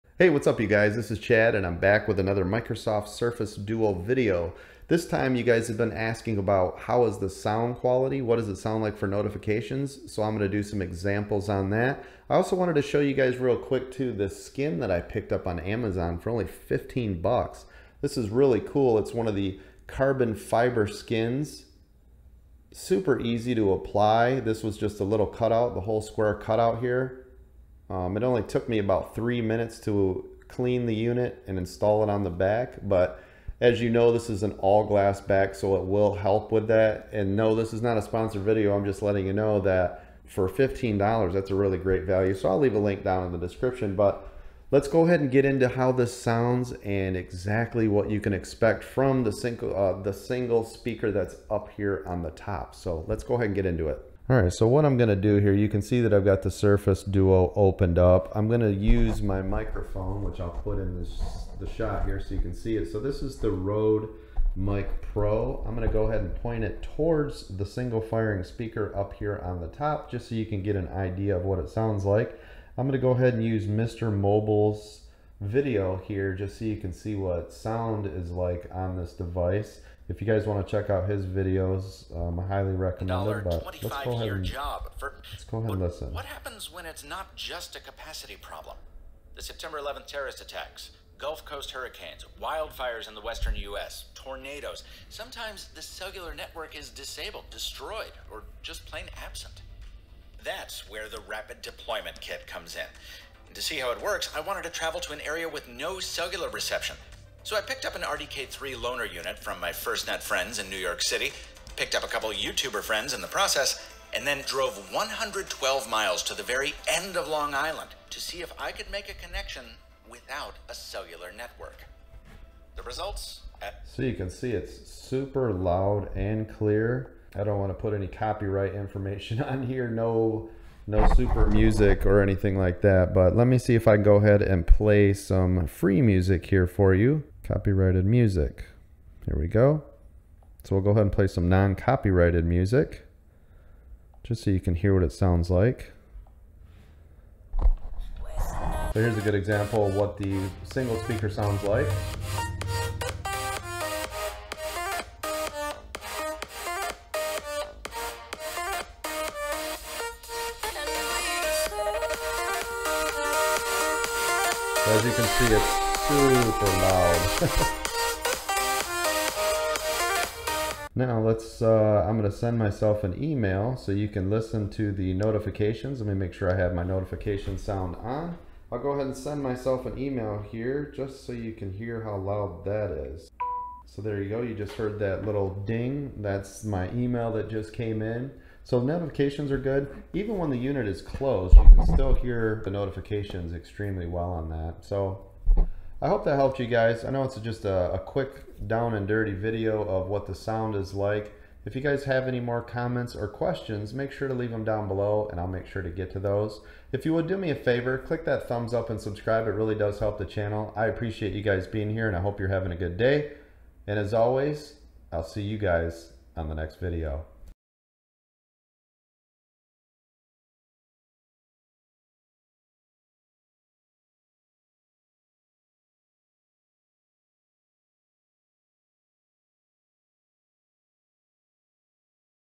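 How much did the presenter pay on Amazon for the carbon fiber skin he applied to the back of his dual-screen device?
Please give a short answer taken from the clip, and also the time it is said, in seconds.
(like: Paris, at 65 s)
$15, at 16 s.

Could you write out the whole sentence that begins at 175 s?
Let me make sure I have my notification sound on.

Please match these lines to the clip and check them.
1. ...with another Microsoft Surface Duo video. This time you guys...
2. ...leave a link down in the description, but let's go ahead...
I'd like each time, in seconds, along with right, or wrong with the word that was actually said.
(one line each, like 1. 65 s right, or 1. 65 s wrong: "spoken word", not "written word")
1. 2 s right
2. 42 s right.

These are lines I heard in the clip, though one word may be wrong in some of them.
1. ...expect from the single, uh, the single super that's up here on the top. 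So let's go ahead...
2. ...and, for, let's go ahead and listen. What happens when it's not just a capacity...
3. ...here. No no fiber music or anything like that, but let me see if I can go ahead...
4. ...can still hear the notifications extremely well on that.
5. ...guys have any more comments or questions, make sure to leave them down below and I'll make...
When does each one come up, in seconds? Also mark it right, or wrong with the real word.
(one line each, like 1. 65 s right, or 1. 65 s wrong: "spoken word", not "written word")
1. 48 s wrong: "speaker", not "super"
2. 84 s right
3. 129 s wrong: "super", not "fiber"
4. 191 s right
5. 201 s right.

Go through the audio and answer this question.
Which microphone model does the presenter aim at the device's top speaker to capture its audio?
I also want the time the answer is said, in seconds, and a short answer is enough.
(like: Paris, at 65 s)
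Rode Mic Pro, at 63 s.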